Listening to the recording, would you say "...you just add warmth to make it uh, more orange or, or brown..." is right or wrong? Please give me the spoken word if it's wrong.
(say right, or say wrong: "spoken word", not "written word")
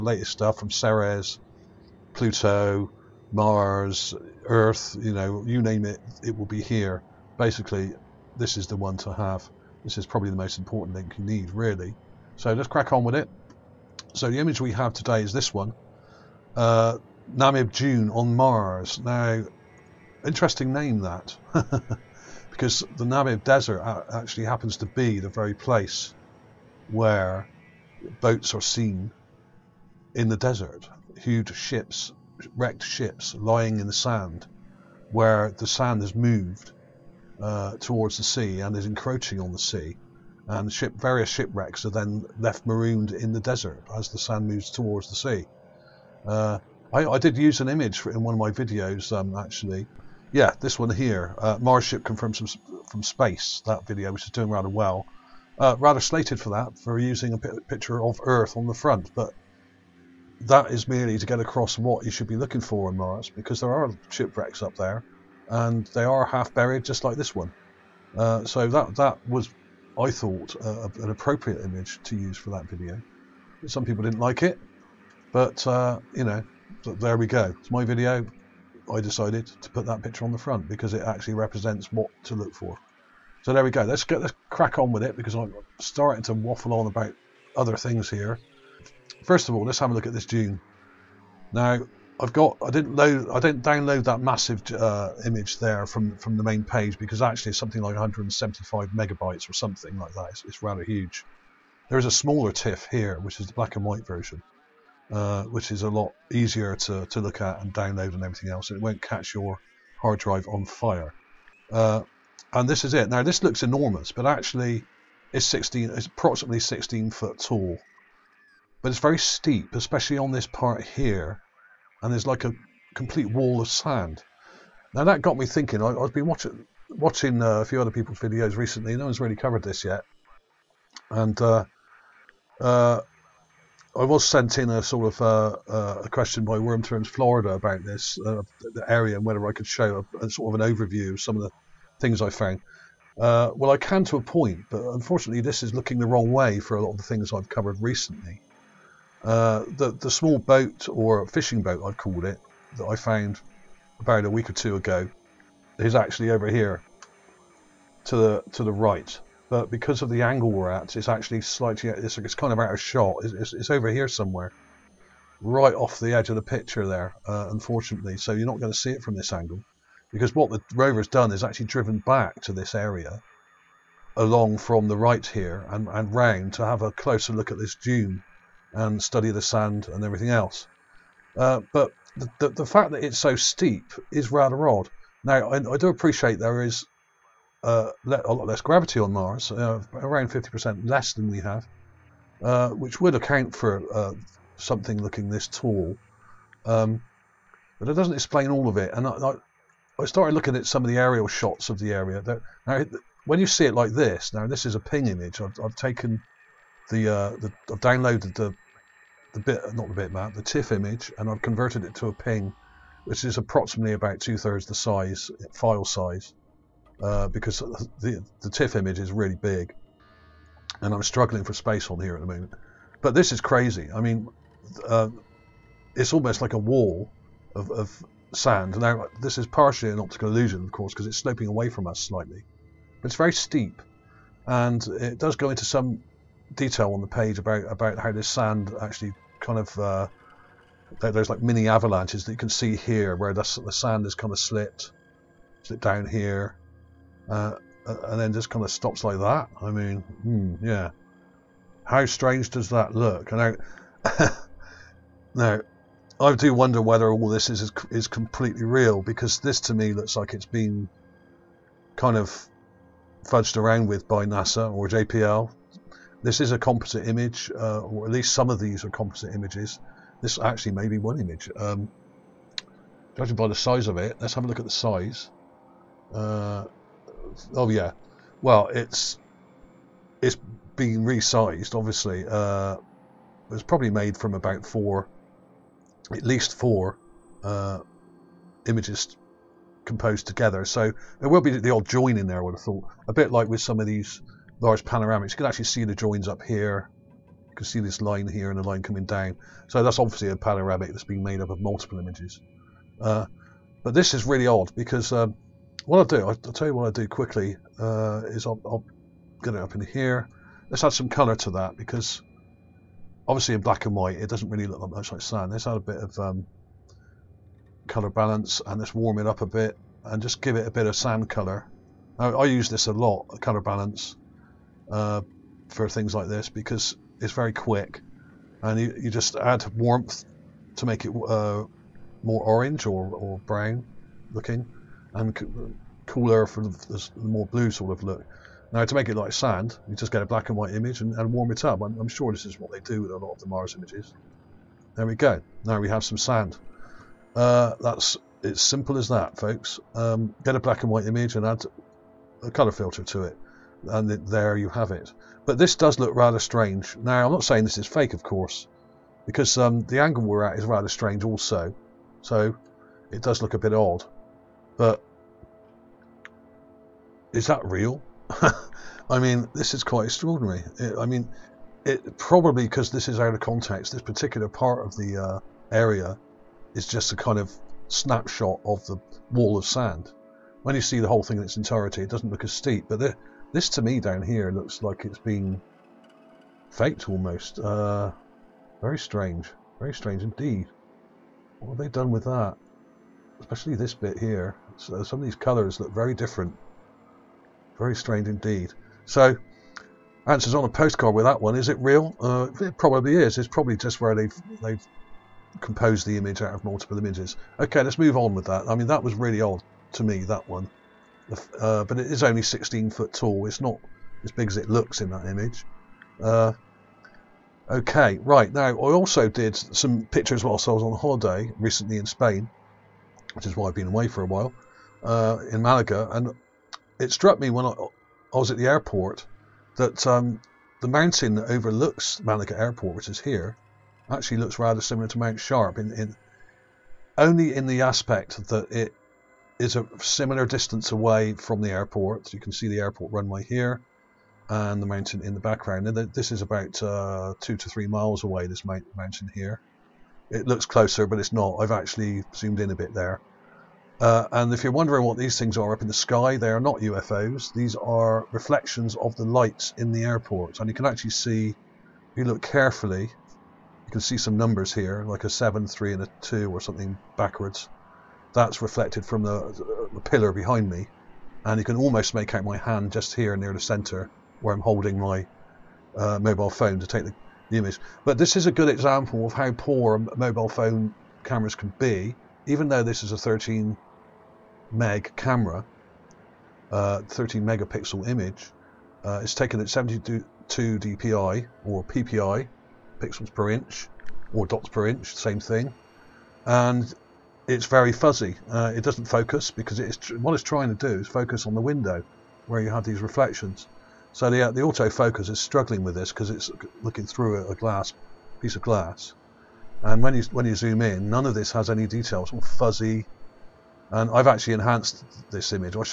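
right.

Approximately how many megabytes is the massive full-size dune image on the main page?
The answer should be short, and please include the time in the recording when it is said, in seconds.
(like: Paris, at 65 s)
175 megabytes, at 97 s.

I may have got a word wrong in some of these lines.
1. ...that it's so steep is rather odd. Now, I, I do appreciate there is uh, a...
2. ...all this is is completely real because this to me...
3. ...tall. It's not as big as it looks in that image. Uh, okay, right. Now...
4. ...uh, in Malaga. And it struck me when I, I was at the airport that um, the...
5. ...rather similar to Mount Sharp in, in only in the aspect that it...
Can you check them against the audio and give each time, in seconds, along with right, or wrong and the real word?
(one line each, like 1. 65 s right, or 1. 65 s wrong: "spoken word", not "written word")
1. 182 s right
2. 257 s right
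3. 413 s right
4. 425 s right
5. 434 s right.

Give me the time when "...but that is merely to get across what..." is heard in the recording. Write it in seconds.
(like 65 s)
59 s.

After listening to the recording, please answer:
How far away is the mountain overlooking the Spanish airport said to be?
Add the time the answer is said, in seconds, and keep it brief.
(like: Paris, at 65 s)
2 to 3 miles, at 447 s.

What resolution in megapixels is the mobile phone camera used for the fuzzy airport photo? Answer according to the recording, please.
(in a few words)
13 megapixel.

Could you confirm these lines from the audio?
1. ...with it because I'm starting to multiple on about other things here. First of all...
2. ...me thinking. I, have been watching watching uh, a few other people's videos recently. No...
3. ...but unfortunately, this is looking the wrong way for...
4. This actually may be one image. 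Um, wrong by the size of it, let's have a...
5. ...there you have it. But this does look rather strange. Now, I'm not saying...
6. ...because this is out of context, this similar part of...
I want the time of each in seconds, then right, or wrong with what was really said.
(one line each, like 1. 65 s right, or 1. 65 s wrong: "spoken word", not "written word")
1. 84 s wrong: "waffle", not "multiple"
2. 125 s right
3. 144 s right
4. 270 s wrong: "judging", not "wrong"
5. 354 s right
6. 372 s wrong: "particular", not "similar".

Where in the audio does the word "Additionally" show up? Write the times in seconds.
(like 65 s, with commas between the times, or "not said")
not said.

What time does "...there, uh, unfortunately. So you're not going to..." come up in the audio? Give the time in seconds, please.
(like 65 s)
166 s.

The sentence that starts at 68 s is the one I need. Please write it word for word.
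Uh, so that that was, I thought, uh, an appropriate image to use for that video.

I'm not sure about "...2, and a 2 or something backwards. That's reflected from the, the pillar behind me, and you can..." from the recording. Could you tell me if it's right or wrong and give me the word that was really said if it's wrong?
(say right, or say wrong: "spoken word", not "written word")
wrong: "3", not "2".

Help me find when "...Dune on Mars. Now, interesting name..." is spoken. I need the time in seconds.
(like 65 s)
17 s.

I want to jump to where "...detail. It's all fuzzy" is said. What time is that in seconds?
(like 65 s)
511 s.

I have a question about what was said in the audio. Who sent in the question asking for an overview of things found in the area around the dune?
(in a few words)
Worm Turns Florida.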